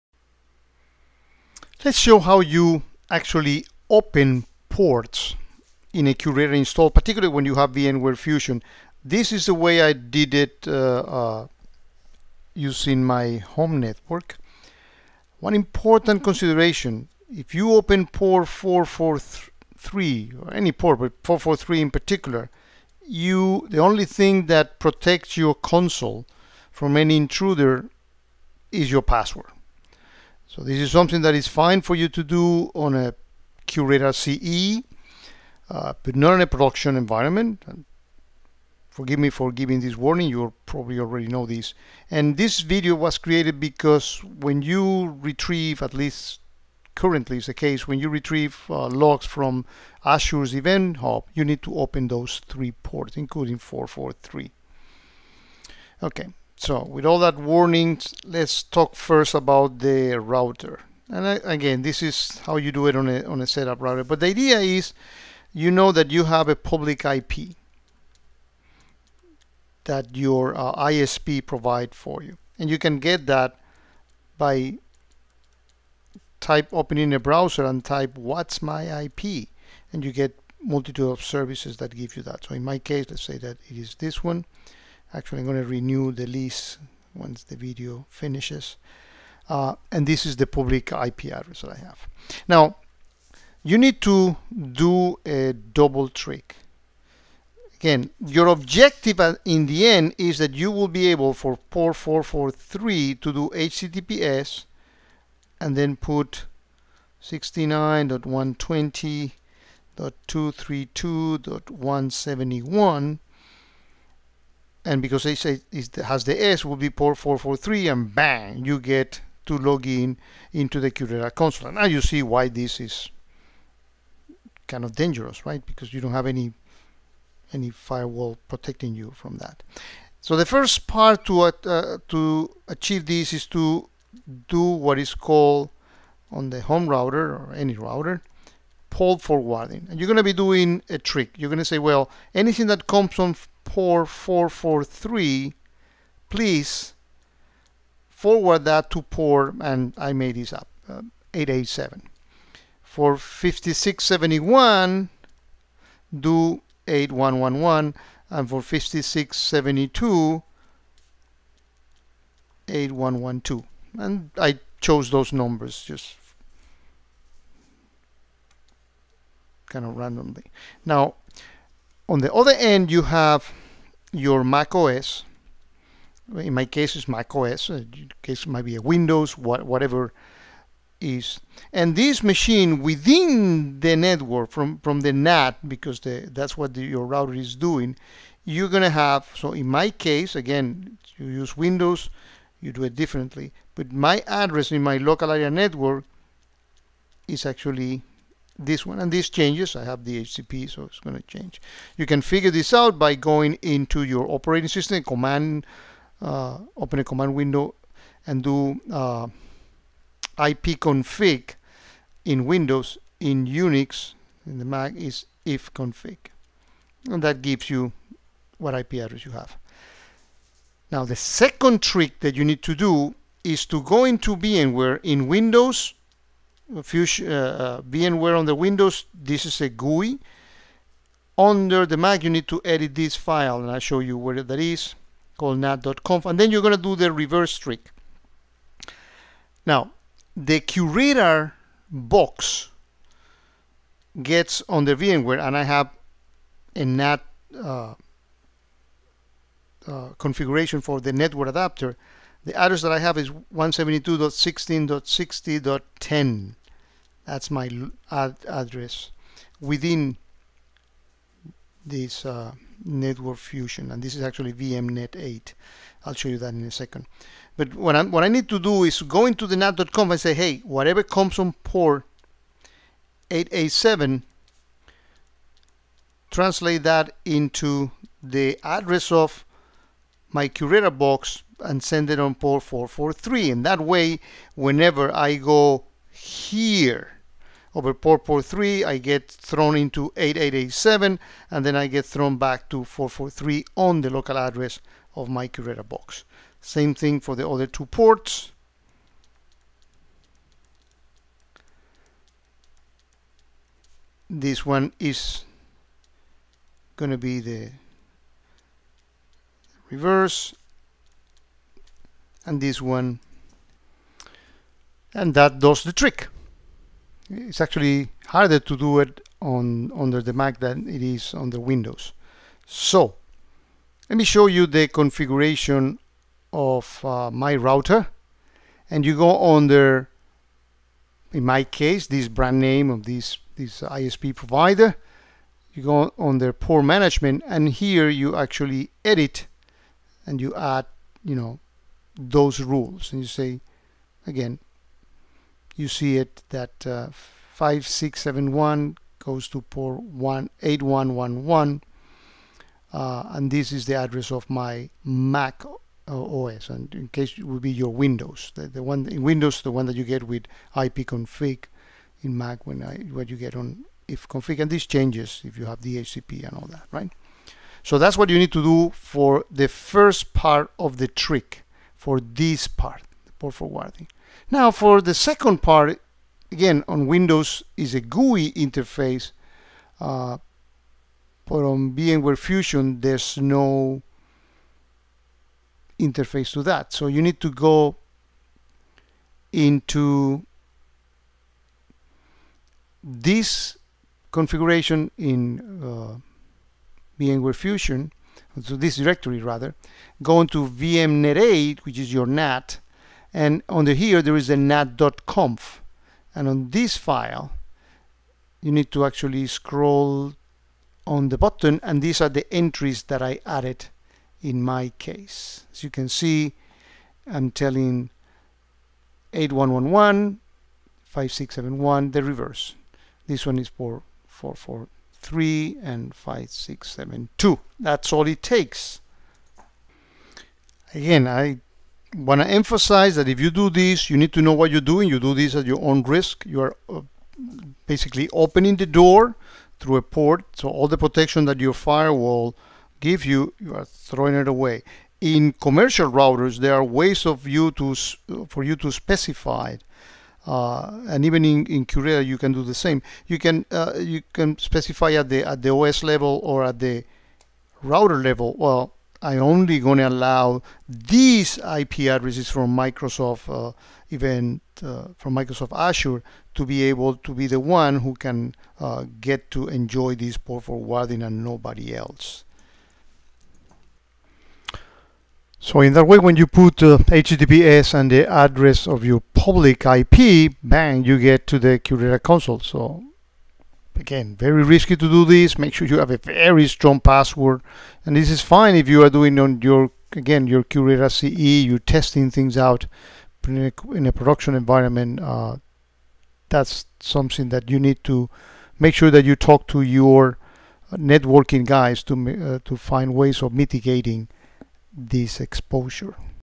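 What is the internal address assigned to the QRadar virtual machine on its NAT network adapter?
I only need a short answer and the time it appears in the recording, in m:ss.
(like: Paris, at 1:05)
172.16.60.10, at 4:13.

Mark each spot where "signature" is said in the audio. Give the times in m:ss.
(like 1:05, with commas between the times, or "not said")
not said.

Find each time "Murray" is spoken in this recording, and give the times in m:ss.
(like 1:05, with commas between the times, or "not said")
not said.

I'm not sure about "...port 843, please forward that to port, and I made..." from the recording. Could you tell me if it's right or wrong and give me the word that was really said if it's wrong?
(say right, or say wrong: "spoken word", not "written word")
wrong: "443", not "843".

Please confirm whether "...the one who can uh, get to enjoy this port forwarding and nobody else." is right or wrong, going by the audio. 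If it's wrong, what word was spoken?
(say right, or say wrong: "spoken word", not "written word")
right.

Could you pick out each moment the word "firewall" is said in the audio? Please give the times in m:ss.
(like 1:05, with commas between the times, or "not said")
2:07, 7:21.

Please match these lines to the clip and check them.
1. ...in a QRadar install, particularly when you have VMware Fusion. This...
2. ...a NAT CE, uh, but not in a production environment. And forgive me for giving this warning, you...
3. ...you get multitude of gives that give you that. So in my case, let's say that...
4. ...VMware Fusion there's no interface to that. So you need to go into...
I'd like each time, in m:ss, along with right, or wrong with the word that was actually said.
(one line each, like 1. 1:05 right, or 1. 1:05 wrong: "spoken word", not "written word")
1. 0:05 right
2. 0:32 wrong: "QRadar", not "NAT"
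3. 1:20 wrong: "services", not "gives"
4. 6:21 right.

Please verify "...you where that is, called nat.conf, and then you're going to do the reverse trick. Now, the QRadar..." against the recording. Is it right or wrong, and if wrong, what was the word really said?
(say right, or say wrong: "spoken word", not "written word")
right.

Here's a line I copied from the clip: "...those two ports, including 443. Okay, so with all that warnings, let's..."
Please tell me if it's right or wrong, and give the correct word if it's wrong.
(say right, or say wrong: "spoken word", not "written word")
wrong: "three", not "two".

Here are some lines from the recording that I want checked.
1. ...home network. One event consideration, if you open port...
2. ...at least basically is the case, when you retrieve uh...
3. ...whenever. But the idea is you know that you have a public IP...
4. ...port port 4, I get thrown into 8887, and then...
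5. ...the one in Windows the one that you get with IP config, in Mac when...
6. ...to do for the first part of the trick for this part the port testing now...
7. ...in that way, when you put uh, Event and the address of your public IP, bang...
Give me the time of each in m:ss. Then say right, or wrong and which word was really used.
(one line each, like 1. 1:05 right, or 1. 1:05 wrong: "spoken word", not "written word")
1. 0:13 wrong: "important", not "event"
2. 0:45 wrong: "currently", not "basically"
3. 1:03 wrong: "router", not "whenever"
4. 4:47 wrong: "3", not "4"
5. 5:58 right
6. 6:08 wrong: "forwarding", not "testing"
7. 7:55 wrong: "HTTPS", not "Event".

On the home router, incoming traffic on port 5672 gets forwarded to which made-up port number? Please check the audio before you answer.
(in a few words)
8112.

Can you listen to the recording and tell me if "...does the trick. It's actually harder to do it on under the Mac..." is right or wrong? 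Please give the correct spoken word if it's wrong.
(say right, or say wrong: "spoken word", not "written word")
right.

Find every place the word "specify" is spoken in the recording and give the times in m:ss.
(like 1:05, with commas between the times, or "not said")
7:28, 7:34.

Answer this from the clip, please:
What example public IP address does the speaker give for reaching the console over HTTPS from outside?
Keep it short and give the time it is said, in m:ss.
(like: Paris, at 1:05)
69.120.232.171, at 1:47.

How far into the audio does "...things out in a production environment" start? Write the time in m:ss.
8:12.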